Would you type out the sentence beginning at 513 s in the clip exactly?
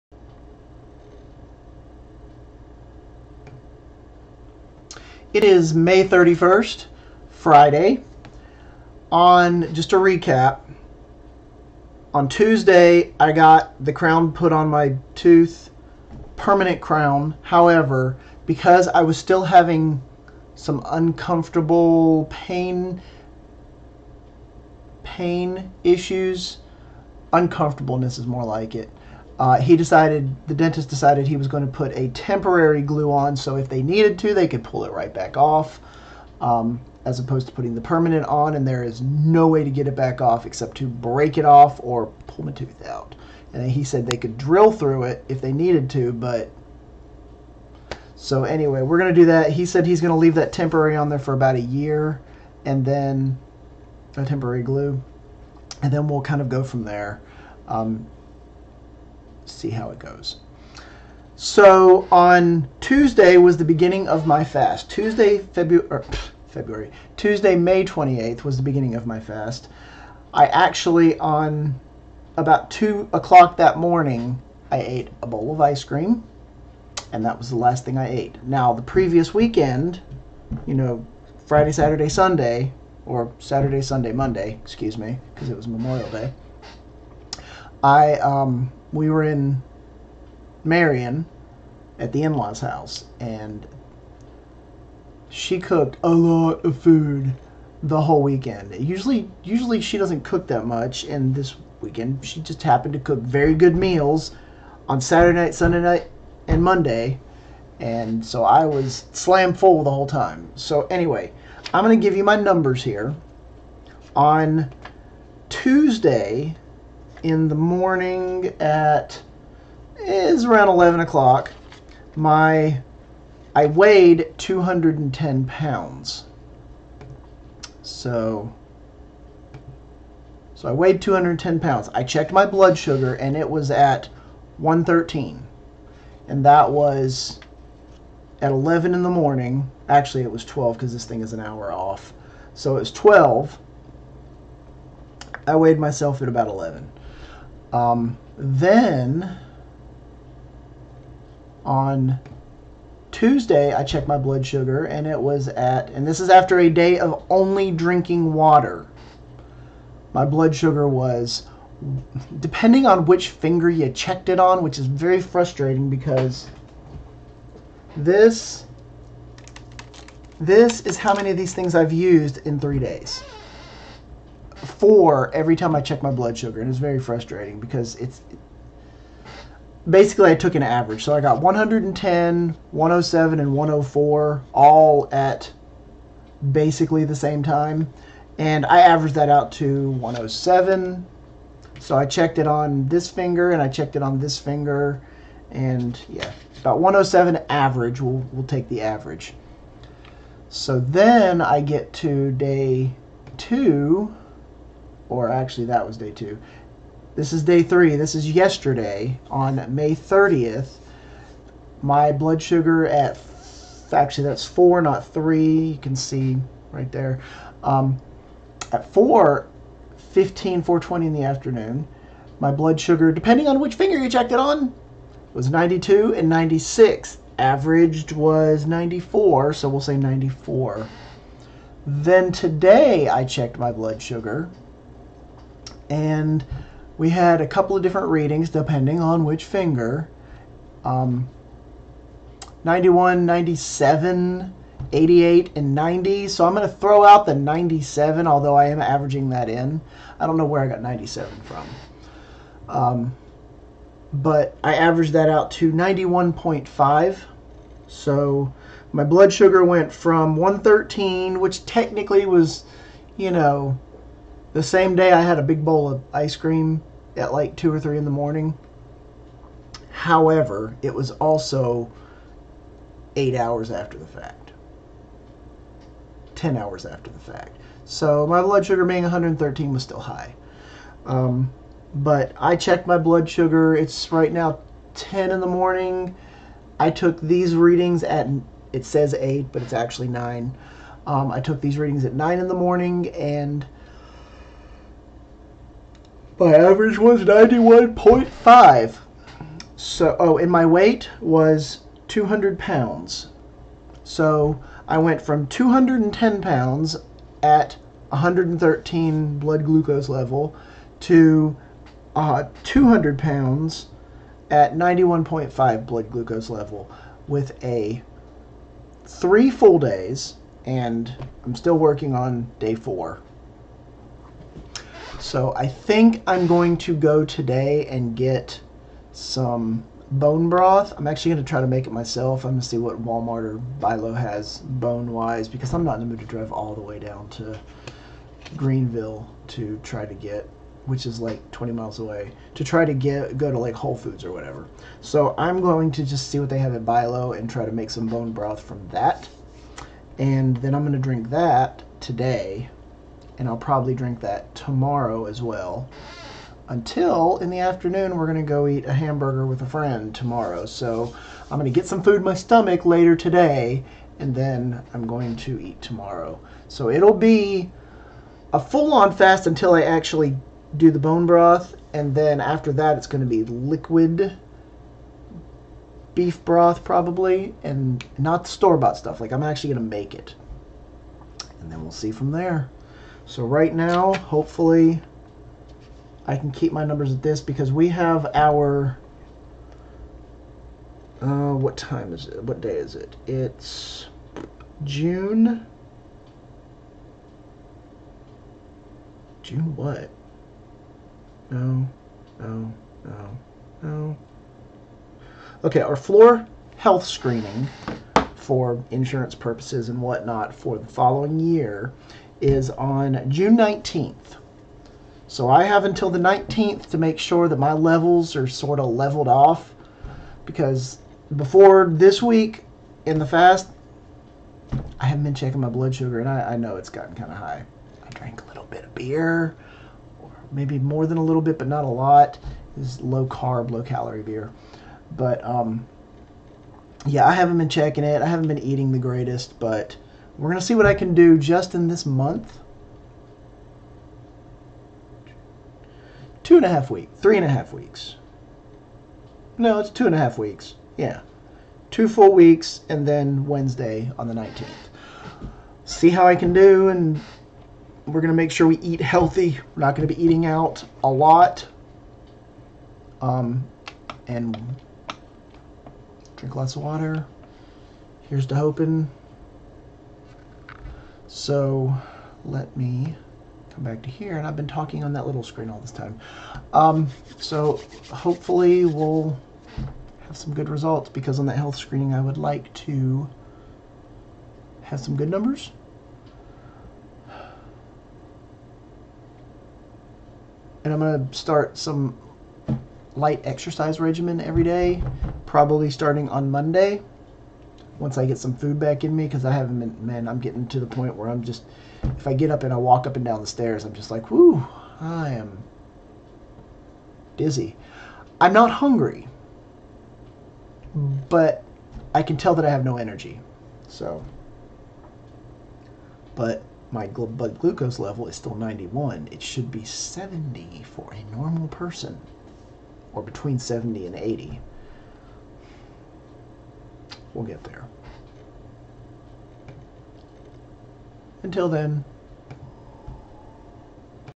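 So, but my blood glucose level is still 91.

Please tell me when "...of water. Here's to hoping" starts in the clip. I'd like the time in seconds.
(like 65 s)
466 s.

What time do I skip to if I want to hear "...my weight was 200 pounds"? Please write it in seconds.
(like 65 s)
300 s.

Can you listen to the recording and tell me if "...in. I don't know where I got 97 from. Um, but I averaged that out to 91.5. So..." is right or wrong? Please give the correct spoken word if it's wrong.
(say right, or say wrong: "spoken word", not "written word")
right.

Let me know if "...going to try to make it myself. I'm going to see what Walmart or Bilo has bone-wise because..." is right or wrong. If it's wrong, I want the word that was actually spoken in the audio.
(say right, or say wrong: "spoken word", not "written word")
right.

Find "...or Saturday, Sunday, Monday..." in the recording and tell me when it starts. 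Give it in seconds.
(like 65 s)
83 s.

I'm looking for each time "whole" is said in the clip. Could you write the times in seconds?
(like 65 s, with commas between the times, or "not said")
98 s, 109 s, 343 s.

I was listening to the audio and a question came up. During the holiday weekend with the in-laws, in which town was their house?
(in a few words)
Marion.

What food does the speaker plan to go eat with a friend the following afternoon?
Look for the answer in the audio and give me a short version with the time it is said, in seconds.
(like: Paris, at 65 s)
hamburger, at 358 s.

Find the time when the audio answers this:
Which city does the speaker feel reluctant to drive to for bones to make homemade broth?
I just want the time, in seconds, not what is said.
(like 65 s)
338 s.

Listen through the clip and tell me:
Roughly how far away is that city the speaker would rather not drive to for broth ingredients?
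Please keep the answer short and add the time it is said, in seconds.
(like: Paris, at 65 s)
20 miles, at 341 s.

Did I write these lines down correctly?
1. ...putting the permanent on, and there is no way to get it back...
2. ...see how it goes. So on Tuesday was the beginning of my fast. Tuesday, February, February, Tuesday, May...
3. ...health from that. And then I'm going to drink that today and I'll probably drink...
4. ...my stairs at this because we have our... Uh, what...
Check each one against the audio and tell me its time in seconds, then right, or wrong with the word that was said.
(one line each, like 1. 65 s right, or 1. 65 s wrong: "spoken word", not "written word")
1. 37 s right
2. 59 s right
3. 348 s wrong: "broth", not "health"
4. 386 s wrong: "numbers", not "stairs".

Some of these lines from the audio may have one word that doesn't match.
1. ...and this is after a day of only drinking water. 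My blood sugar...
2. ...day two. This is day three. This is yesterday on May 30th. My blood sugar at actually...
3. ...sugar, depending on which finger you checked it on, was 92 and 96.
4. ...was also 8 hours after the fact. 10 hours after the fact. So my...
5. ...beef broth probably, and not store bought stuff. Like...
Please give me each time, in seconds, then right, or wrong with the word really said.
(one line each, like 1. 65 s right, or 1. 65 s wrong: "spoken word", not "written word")
1. 155 s right
2. 205 s right
3. 222 s right
4. 270 s right
5. 376 s right.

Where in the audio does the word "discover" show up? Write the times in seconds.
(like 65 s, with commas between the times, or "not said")
not said.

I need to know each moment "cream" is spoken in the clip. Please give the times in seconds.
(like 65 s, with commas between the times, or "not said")
75 s, 266 s.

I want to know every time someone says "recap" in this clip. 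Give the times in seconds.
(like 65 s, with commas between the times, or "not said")
9 s.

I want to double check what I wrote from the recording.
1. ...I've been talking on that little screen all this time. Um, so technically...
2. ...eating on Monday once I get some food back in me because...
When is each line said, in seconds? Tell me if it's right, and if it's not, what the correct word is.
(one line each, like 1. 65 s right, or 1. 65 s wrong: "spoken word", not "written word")
1. 474 s wrong: "hopefully", not "technically"
2. 495 s wrong: "starting", not "eating".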